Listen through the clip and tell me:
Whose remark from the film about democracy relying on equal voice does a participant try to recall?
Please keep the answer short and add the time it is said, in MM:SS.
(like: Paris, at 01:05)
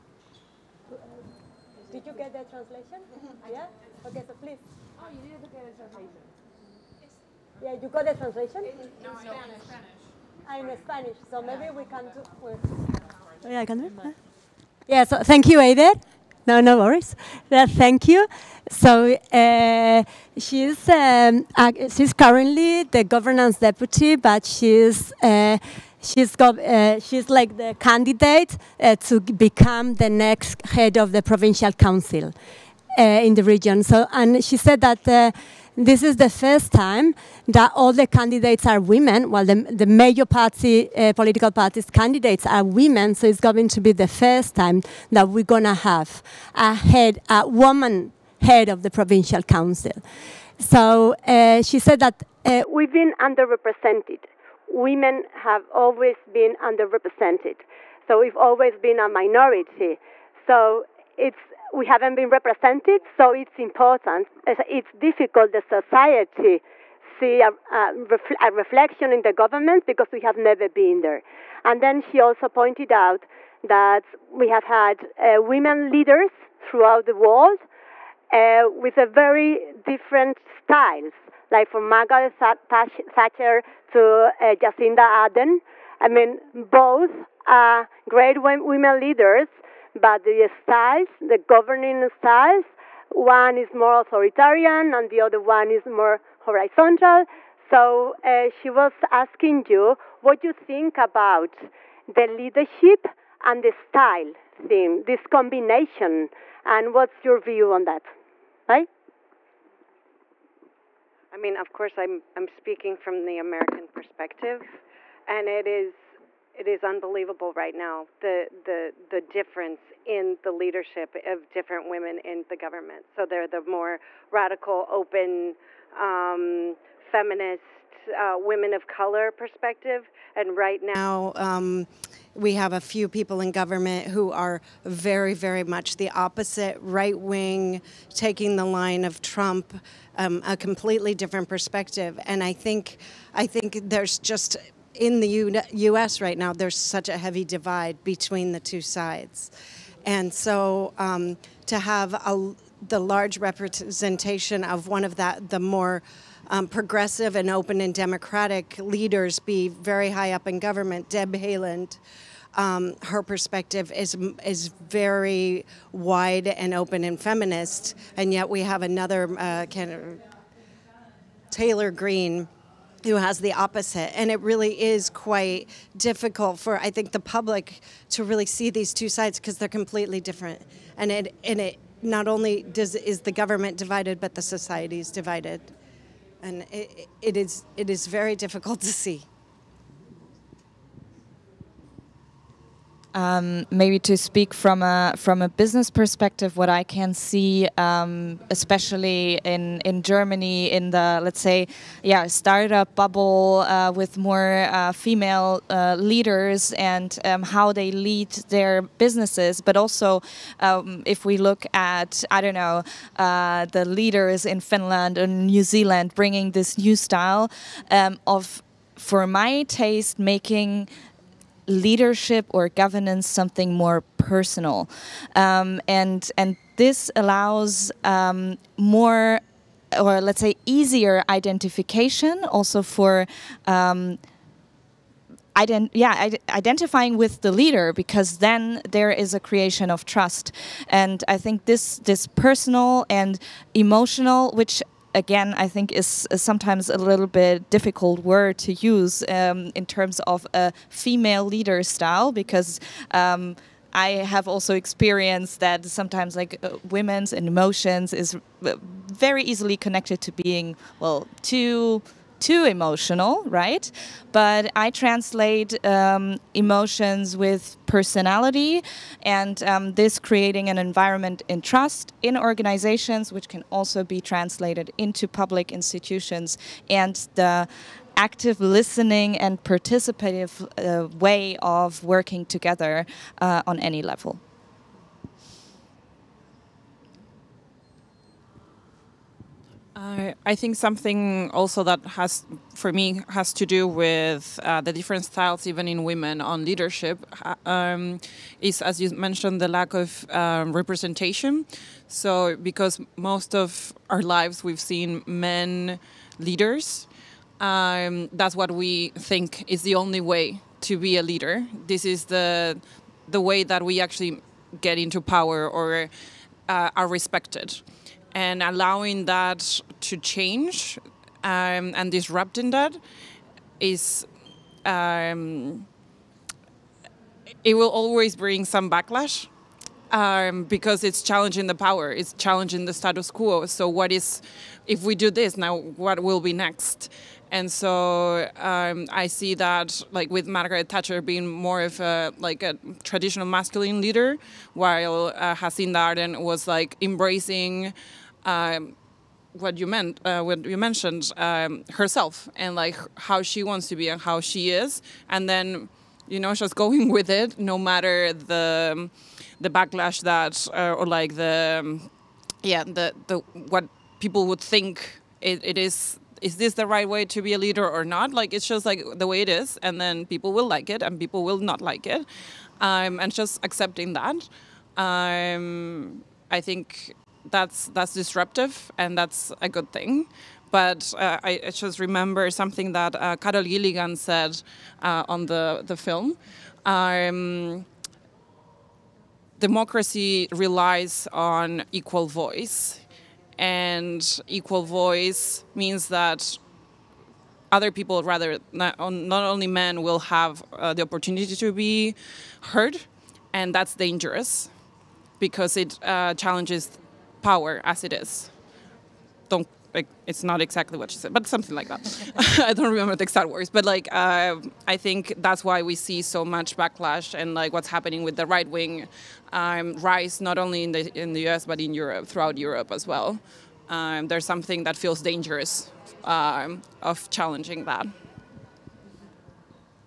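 Carol Gilligan, at 06:23.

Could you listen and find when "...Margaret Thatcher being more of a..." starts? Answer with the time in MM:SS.
05:40.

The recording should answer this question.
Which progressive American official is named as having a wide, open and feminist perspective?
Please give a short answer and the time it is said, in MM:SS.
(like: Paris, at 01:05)
Deb Haaland, at 02:41.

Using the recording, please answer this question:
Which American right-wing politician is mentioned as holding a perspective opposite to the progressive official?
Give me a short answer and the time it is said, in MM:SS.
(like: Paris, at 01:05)
Taylor Greene, at 02:51.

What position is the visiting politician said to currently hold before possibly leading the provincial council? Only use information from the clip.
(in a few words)
Governance deputy.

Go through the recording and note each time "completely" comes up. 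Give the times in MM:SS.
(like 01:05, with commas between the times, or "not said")
02:20, 02:59.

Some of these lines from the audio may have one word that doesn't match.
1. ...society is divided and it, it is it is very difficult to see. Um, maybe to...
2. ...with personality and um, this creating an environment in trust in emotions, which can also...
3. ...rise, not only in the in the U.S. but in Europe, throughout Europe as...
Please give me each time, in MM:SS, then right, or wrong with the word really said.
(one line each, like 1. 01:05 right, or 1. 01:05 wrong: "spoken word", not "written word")
1. 03:04 right
2. 04:27 wrong: "organizations", not "emotions"
3. 06:59 right.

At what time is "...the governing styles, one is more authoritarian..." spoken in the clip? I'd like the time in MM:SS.
01:31.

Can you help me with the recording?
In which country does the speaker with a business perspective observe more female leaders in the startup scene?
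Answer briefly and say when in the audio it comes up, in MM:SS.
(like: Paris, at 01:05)
Germany, at 03:20.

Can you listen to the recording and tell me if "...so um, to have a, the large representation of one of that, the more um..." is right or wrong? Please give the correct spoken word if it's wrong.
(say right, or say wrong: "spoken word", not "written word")
right.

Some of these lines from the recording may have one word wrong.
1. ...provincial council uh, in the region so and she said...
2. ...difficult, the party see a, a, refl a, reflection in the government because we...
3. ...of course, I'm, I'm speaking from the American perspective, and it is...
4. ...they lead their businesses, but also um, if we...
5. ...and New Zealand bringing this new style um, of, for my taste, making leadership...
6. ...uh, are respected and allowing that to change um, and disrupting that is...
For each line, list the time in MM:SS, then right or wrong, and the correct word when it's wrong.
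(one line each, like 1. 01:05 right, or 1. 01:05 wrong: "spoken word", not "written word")
1. 00:31 right
2. 01:04 wrong: "society", not "party"
3. 01:51 right
4. 03:27 right
5. 03:35 right
6. 05:16 right.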